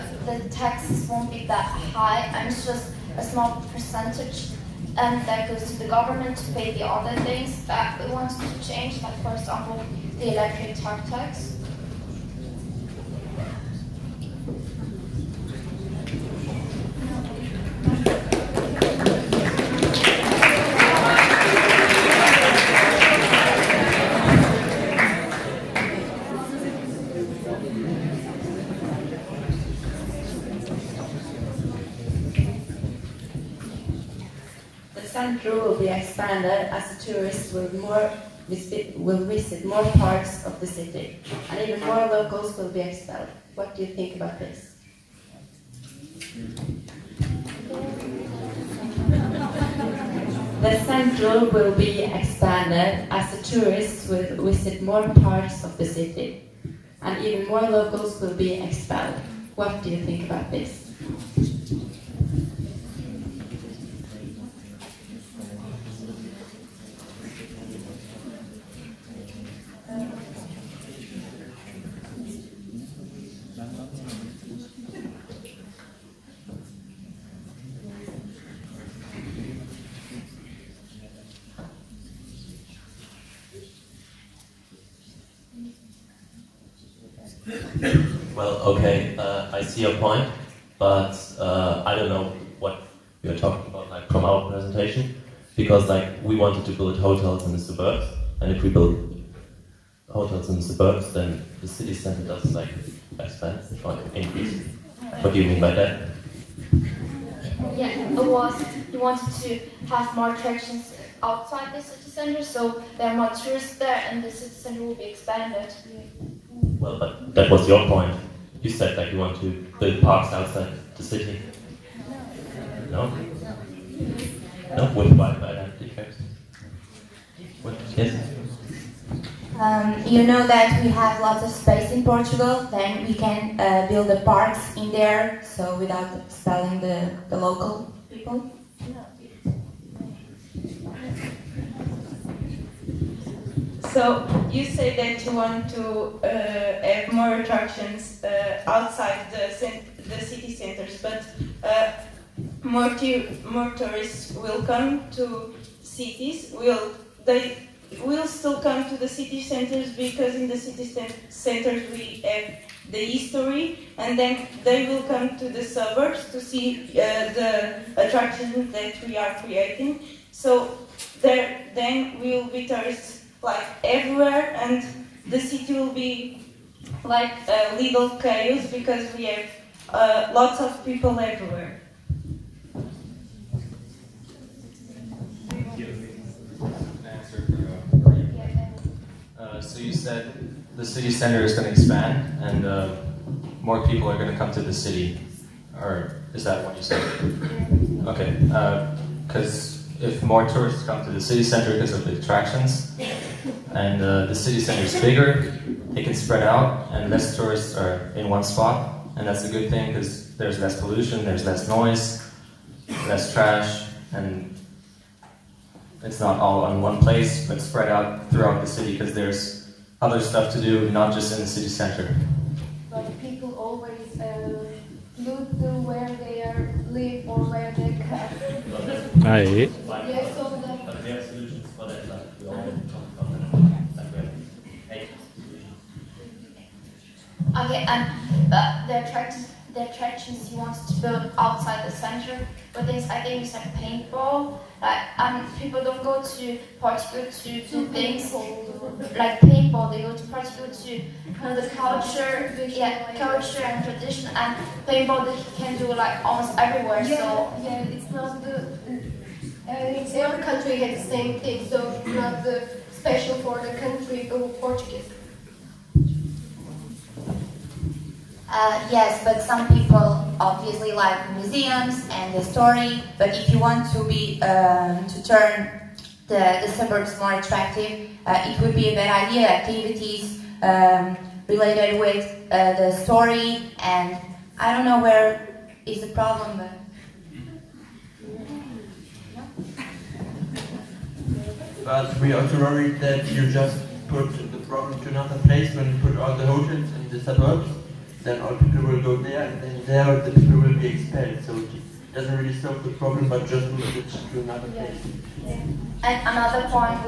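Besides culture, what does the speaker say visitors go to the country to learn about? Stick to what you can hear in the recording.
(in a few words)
tradition.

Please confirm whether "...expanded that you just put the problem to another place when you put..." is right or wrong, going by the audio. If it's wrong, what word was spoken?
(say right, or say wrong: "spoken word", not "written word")
wrong: "worried", not "expanded".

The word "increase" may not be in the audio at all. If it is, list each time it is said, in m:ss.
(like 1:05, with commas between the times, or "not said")
1:44.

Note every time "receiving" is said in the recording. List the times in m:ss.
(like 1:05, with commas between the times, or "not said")
not said.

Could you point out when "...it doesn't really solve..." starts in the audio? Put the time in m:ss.
5:01.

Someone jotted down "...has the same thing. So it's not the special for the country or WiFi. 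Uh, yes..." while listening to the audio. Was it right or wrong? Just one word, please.
wrong.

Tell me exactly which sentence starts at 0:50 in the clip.
The central will be expanded as the tourists will visit more parts of the city and even more locals will be expelled.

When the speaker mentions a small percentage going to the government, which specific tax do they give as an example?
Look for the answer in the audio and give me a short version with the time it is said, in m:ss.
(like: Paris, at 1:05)
electric tax, at 0:10.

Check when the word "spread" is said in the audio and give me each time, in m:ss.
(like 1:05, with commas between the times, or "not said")
3:26, 3:37.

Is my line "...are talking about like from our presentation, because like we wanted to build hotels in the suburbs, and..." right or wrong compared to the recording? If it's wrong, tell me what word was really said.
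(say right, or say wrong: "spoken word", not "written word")
right.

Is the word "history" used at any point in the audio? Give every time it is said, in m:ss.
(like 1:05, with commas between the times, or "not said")
2:42.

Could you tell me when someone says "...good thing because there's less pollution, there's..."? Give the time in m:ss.
3:29.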